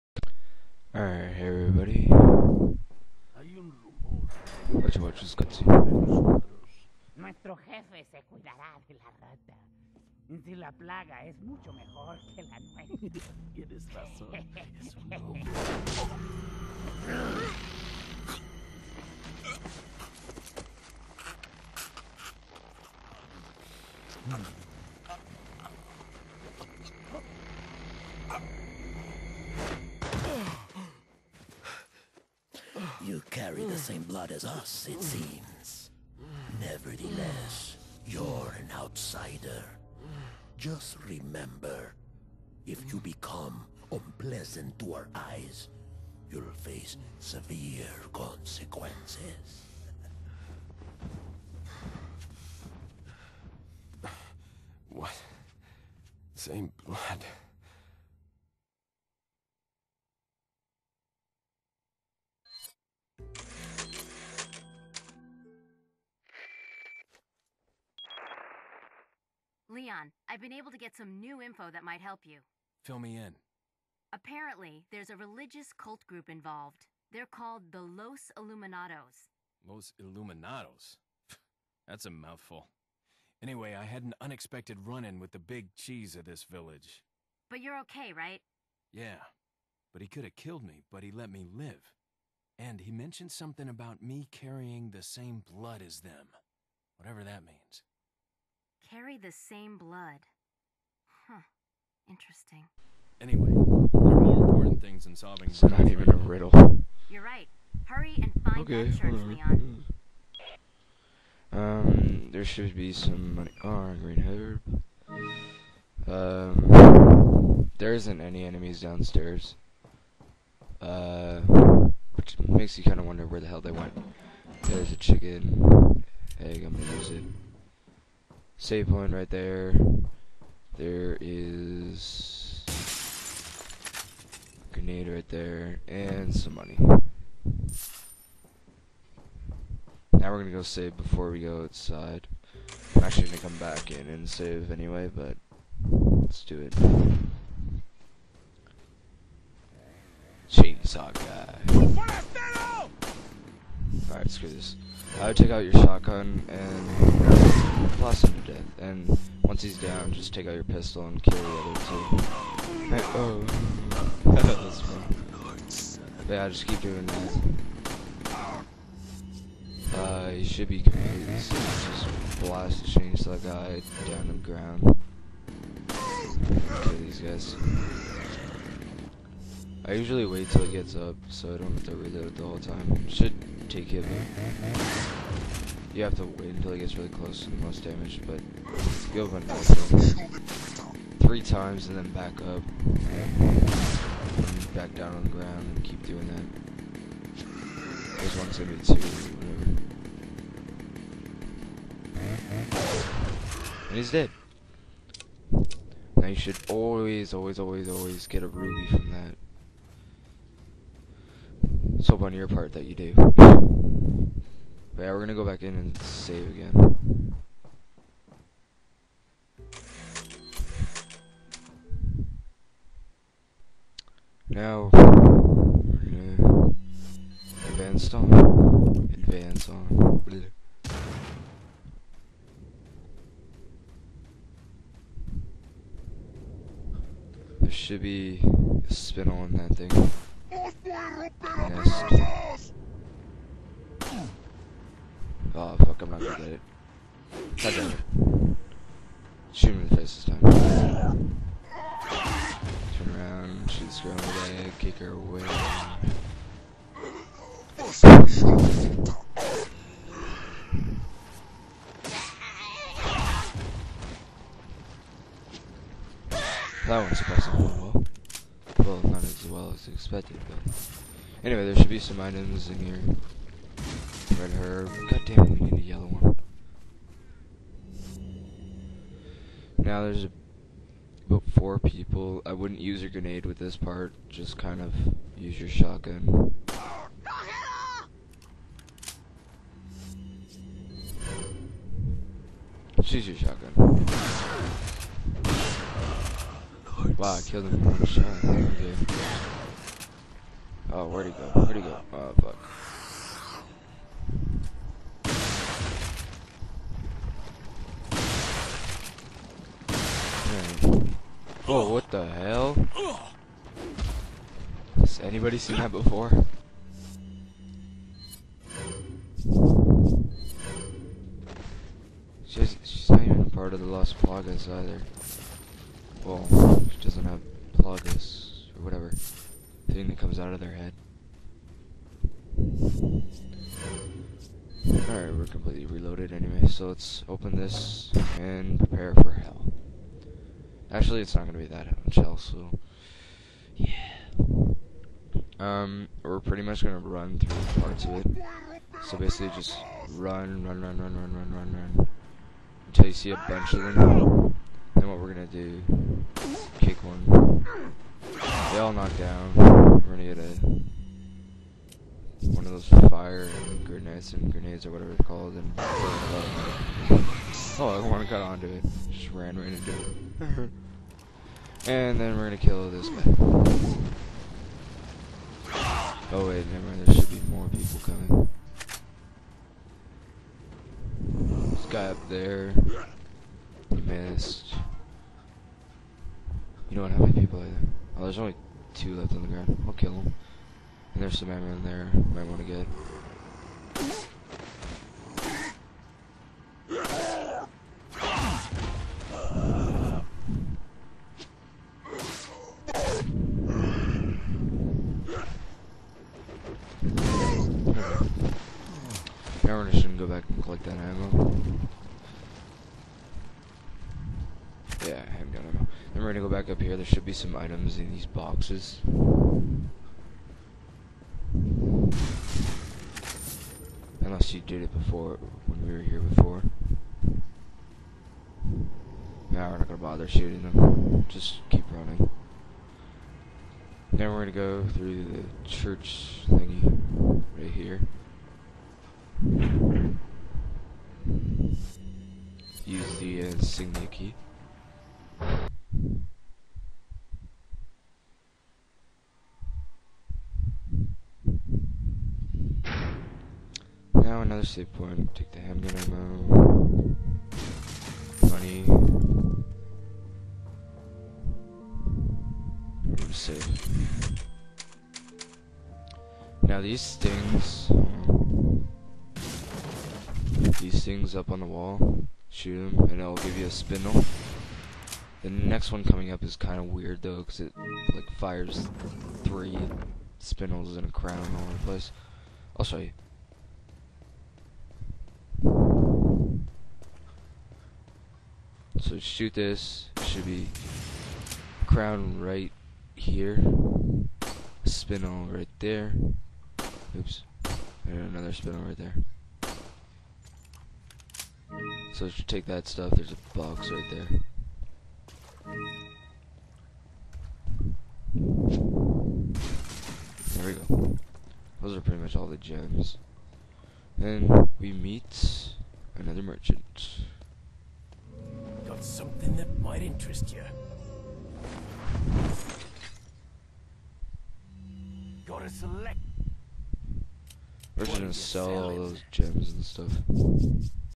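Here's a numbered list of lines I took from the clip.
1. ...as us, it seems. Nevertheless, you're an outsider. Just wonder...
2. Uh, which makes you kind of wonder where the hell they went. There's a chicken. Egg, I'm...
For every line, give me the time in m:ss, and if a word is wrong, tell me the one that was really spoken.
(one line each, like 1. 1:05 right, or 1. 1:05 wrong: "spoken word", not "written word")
1. 0:34 wrong: "remember", not "wonder"
2. 2:00 right.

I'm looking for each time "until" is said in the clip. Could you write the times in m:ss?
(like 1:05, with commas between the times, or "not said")
3:06, 5:52.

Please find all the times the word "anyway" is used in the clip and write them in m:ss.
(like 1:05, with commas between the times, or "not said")
1:23, 1:43, 2:24, 4:31, 5:36.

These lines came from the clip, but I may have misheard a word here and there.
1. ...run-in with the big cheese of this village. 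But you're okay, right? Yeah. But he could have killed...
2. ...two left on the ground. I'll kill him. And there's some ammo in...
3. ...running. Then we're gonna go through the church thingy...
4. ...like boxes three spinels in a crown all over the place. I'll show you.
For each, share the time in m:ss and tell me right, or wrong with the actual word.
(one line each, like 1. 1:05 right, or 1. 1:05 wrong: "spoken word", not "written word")
1. 1:24 right
2. 6:28 right
3. 7:11 right
4. 7:58 wrong: "fires", not "boxes".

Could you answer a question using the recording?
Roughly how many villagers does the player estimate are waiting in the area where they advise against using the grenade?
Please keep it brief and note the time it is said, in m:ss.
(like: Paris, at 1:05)
4, at 4:41.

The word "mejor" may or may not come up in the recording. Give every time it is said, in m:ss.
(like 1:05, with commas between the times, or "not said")
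0:11.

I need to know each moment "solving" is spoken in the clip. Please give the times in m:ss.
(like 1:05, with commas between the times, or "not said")
1:45.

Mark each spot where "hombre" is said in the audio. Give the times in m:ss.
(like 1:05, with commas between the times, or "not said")
0:15.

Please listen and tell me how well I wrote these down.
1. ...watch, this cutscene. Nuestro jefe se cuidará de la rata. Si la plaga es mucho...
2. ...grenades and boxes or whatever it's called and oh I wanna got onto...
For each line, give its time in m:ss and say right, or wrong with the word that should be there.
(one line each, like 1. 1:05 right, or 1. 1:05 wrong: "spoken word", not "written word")
1. 0:04 right
2. 6:03 wrong: "grenades", not "boxes".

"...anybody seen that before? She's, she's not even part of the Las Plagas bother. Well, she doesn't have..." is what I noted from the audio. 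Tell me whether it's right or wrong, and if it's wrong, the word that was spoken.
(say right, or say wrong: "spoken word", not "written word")
wrong: "either", not "bother".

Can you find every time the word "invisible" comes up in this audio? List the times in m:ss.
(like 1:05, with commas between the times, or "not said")
not said.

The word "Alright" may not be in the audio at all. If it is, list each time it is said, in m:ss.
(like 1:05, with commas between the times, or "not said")
0:00, 2:34, 5:32.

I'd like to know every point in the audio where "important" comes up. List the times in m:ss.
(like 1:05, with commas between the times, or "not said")
1:44.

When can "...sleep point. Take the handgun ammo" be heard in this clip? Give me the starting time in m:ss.
7:34.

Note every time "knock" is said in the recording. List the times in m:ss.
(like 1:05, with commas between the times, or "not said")
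5:58.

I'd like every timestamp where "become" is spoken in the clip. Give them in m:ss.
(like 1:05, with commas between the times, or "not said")
0:42.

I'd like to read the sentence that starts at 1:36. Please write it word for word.
Whatever that means carry the same blood.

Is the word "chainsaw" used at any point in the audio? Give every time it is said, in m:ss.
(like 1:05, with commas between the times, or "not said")
2:30, 2:52.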